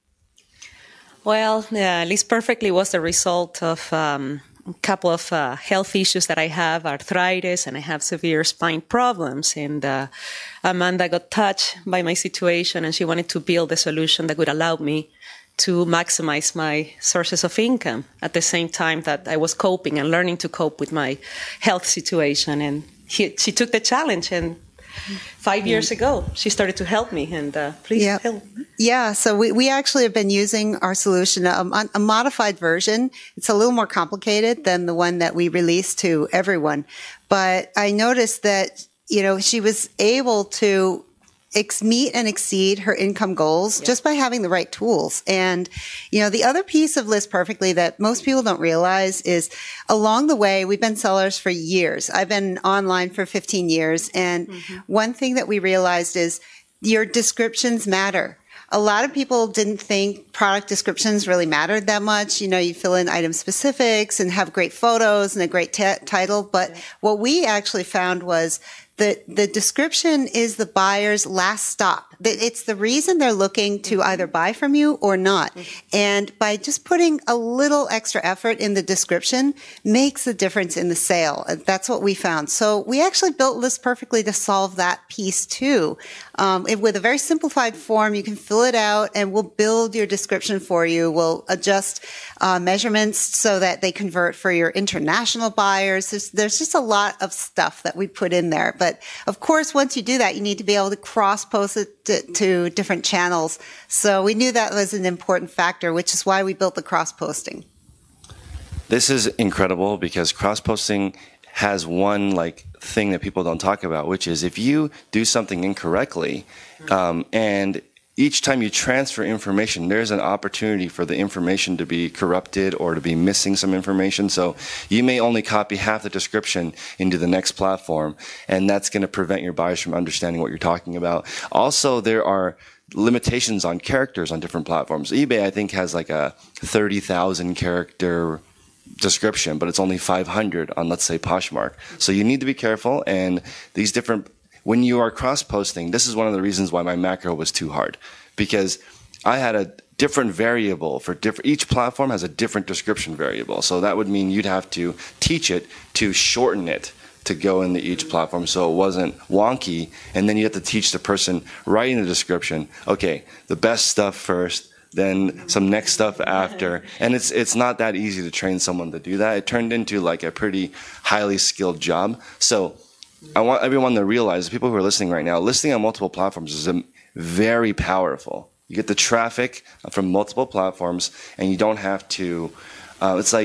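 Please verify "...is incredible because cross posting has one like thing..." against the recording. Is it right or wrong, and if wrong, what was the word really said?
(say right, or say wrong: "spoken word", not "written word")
right.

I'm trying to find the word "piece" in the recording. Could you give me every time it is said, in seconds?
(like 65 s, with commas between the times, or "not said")
46 s, 85 s.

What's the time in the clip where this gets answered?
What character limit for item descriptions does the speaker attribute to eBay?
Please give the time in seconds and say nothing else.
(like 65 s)
136 s.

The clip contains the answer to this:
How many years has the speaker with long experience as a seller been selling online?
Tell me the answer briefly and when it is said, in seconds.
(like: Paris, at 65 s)
15 years, at 53 s.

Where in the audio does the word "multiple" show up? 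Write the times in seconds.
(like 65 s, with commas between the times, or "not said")
175 s, 180 s.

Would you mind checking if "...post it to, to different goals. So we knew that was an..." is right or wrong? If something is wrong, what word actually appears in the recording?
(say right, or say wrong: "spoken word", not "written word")
wrong: "channels", not "goals".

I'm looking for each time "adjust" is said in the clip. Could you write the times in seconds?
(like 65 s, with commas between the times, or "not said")
91 s.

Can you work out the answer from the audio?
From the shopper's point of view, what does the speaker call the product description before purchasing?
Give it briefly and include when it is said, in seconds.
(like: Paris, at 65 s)
the buyer's last stop, at 70 s.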